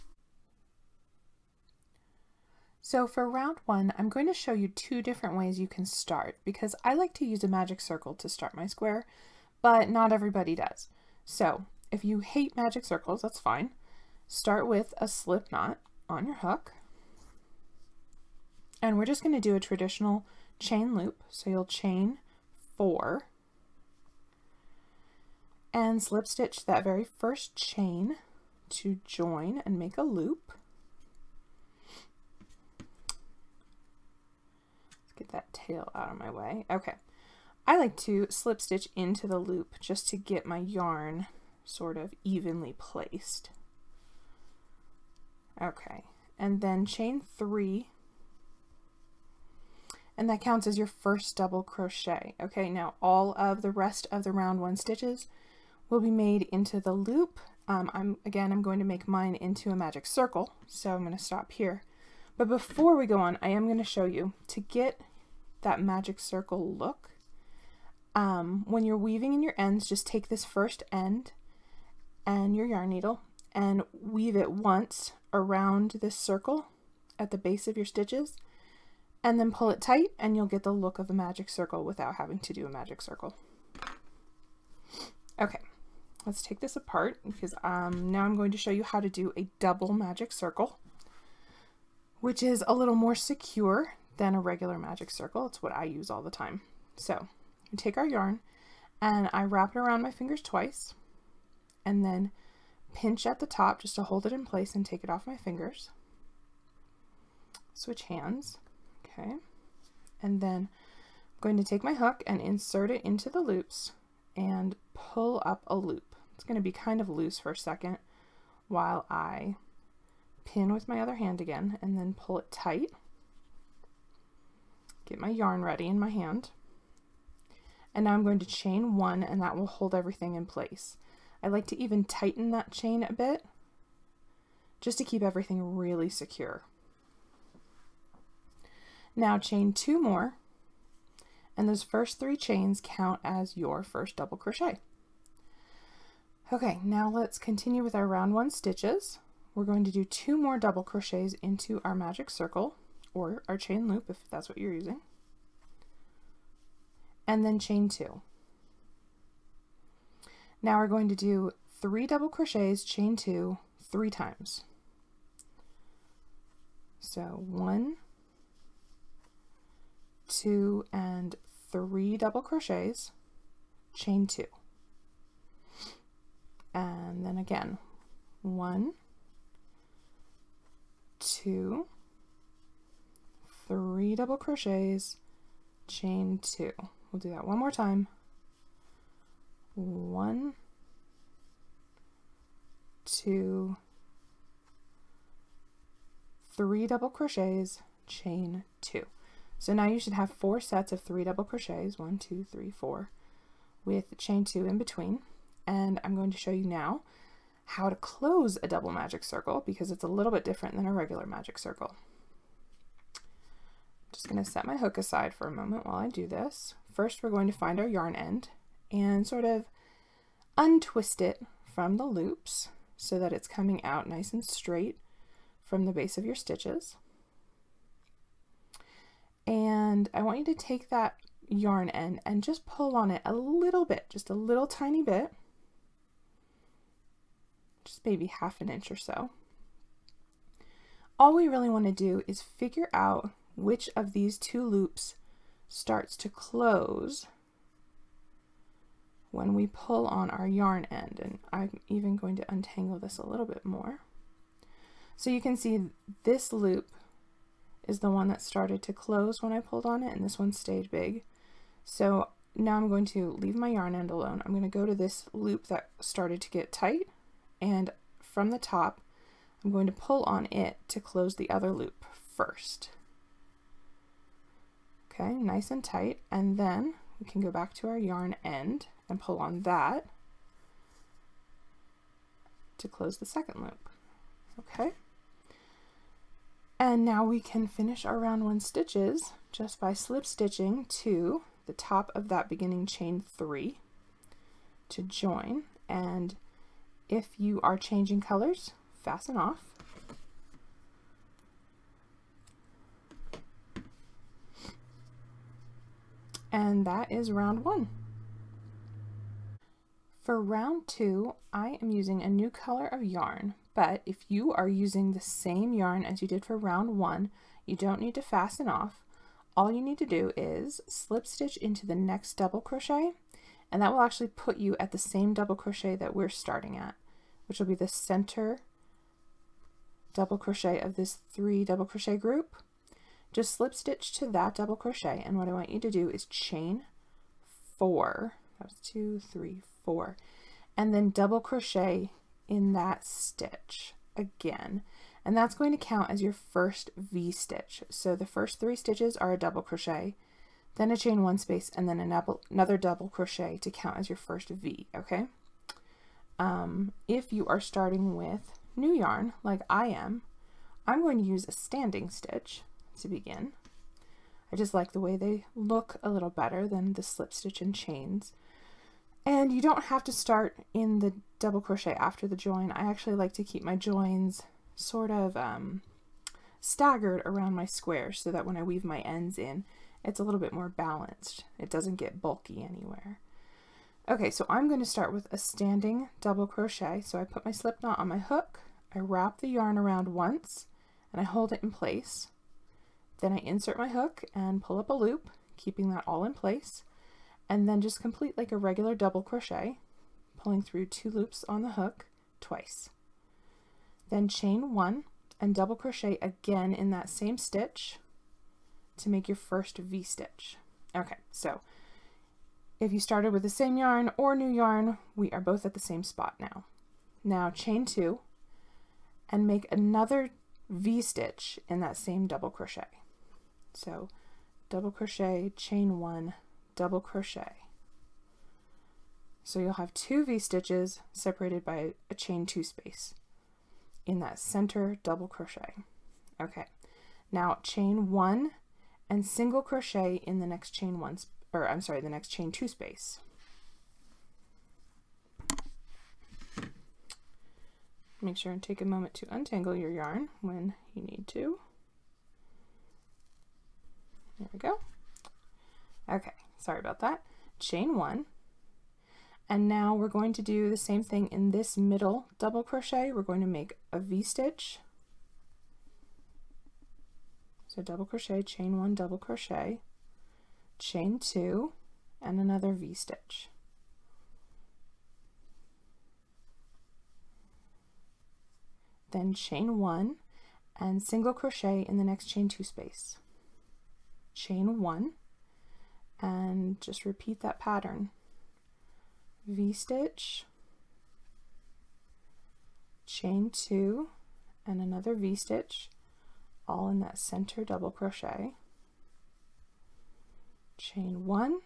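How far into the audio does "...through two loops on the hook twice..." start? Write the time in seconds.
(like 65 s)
400 s.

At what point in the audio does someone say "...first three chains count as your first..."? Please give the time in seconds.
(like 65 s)
141 s.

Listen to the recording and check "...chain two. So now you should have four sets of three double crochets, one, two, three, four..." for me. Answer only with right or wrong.
right.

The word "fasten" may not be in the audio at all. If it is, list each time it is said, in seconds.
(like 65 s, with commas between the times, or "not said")
299 s, 318 s.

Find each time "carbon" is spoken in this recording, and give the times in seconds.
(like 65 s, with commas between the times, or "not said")
not said.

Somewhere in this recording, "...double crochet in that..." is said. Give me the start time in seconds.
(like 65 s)
341 s.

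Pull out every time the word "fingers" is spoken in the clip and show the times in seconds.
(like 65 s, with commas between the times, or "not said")
100 s, 105 s.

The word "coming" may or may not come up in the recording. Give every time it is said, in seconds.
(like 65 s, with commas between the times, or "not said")
223 s.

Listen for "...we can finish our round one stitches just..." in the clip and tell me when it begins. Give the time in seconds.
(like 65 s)
287 s.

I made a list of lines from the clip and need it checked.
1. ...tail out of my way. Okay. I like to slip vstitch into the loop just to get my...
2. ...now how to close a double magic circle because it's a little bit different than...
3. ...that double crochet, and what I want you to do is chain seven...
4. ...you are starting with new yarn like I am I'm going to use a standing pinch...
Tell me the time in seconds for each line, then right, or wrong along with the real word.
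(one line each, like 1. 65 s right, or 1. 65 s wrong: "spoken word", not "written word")
1. 35 s wrong: "stitch", not "vstitch"
2. 206 s right
3. 334 s wrong: "four", not "seven"
4. 357 s wrong: "stitch", not "pinch".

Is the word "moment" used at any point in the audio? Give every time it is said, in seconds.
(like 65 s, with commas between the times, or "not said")
215 s, 448 s.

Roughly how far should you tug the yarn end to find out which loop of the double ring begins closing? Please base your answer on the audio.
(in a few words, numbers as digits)
half an inch.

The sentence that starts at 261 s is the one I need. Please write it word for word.
So now I'm going to leave my yarn end alone.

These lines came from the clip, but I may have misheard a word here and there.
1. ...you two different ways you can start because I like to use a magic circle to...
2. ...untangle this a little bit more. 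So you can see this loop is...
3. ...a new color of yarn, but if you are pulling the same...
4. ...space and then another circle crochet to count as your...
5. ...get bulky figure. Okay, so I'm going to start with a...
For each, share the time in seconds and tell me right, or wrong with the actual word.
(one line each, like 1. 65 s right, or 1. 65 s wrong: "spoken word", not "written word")
1. 4 s right
2. 252 s right
3. 312 s wrong: "using", not "pulling"
4. 351 s wrong: "double", not "circle"
5. 381 s wrong: "anywhere", not "figure".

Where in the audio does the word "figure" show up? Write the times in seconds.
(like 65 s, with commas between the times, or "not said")
242 s.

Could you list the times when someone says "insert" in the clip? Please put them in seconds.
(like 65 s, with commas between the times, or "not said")
112 s, 393 s.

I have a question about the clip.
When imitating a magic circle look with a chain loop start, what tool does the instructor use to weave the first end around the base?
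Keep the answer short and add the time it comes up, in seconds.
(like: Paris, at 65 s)
yarn needle, at 72 s.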